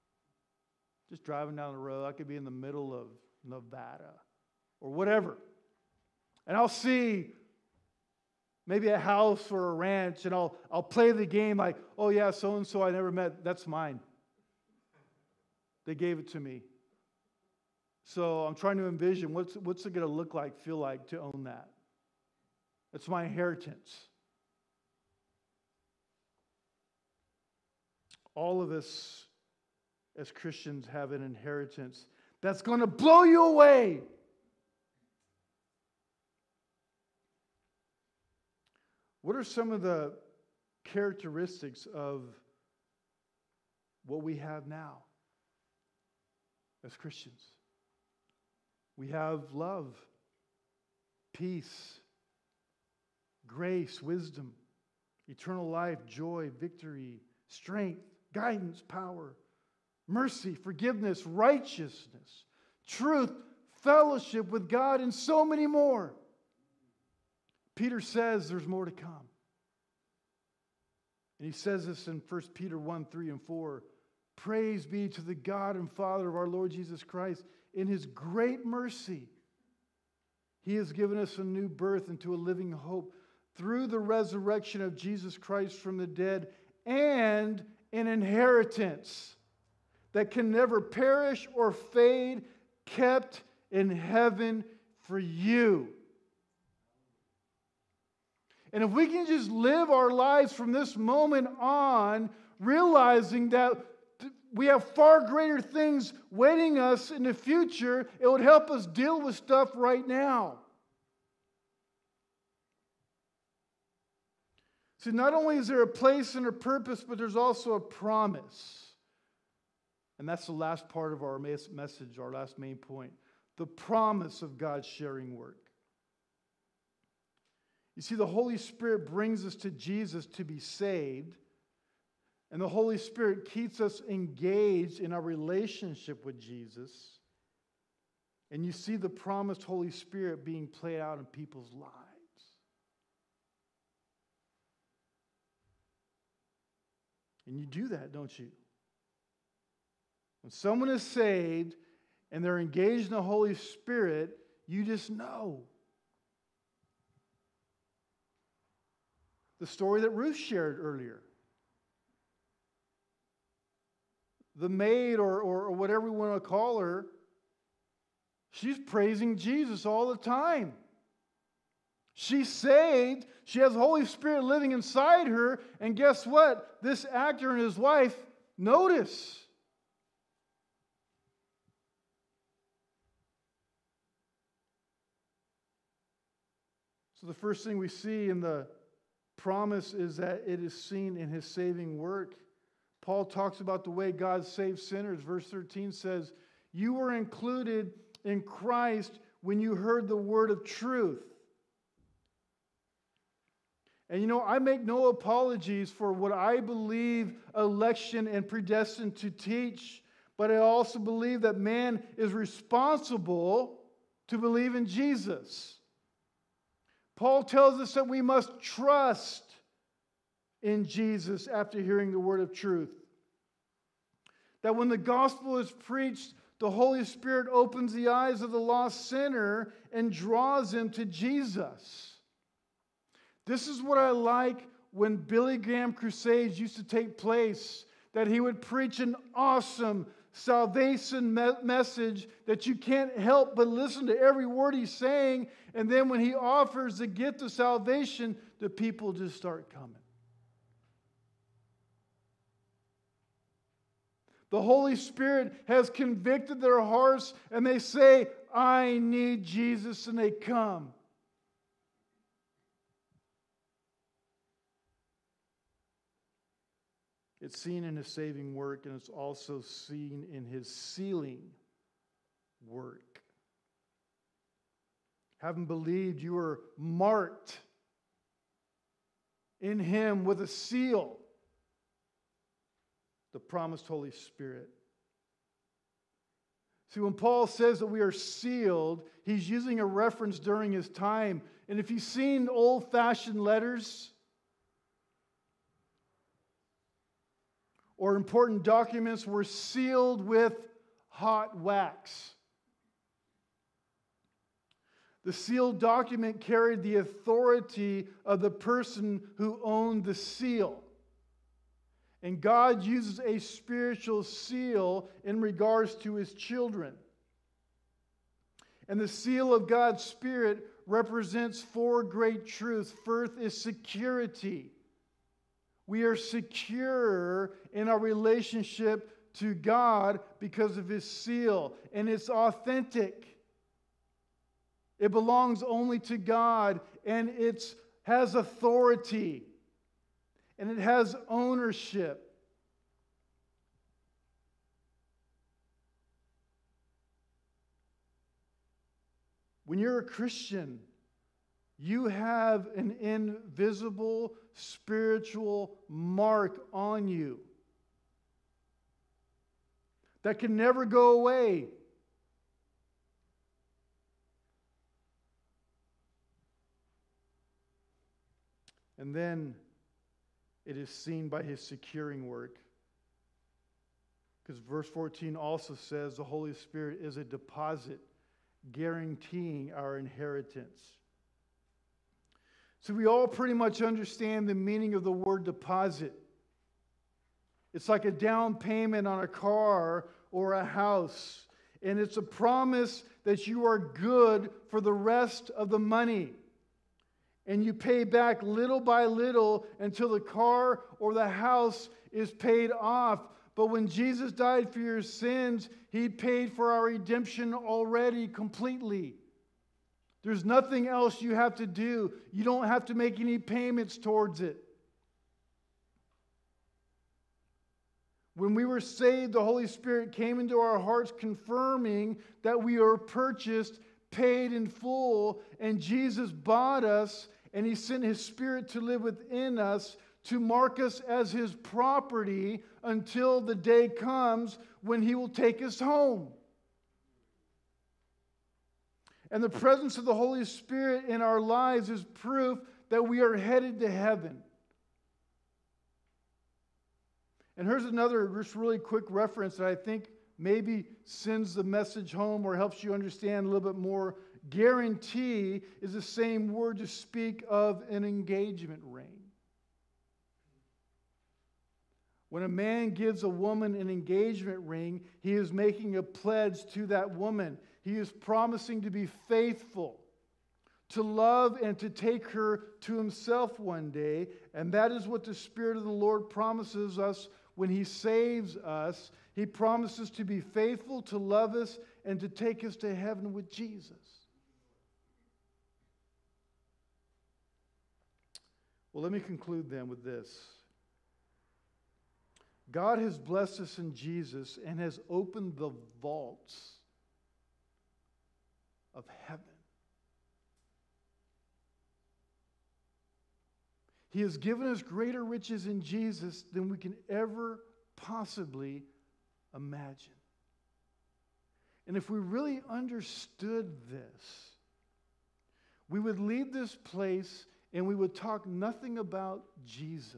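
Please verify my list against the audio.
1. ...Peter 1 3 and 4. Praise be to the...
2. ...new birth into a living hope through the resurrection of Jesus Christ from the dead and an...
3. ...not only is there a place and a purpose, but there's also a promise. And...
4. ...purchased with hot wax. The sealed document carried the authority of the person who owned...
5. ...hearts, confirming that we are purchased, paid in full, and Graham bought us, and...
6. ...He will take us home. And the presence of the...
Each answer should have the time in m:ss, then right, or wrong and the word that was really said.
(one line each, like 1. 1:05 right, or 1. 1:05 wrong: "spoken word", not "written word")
1. 1:12 right
2. 1:21 right
3. 1:55 right
4. 4:59 wrong: "sealed", not "purchased"
5. 7:00 wrong: "Jesus", not "Graham"
6. 7:15 right.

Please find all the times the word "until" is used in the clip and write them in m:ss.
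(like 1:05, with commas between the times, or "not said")
6:39, 7:12.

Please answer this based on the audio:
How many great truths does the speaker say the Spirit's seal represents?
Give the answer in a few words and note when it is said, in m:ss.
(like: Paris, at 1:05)
4, at 5:21.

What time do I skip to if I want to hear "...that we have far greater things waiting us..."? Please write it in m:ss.
1:43.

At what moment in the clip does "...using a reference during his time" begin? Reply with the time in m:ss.
4:49.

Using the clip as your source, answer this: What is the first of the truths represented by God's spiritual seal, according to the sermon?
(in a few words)
security.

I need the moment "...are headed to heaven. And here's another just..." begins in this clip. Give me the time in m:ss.
7:23.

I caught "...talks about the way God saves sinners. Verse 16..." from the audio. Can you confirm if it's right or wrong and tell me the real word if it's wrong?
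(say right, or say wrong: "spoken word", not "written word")
wrong: "13", not "16".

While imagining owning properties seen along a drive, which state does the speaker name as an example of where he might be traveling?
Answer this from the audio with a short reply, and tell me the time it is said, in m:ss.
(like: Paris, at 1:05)
Nevada, at 0:03.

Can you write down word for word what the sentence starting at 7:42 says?
When a man gives a woman an engagement ring, he is making a pledge to that woman.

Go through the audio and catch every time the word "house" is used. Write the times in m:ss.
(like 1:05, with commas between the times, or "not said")
0:08, 6:30, 6:41.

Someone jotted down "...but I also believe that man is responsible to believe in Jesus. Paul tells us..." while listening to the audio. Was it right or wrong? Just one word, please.
right.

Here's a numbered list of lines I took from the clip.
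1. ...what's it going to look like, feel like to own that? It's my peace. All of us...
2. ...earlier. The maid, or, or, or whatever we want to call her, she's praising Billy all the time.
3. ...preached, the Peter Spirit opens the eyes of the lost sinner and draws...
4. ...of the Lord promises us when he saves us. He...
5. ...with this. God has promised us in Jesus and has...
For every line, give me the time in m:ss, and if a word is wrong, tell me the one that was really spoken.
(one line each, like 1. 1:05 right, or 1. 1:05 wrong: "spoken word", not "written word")
1. 0:19 wrong: "inheritance", not "peace"
2. 2:40 wrong: "Jesus", not "Billy"
3. 3:45 wrong: "Holy", not "Peter"
4. 7:55 right
5. 8:09 wrong: "blessed", not "promised".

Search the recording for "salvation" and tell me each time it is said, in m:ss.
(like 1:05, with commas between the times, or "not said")
4:00, 4:07.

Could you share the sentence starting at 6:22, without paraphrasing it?
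So we all pretty much understand the meaning of the word deposit.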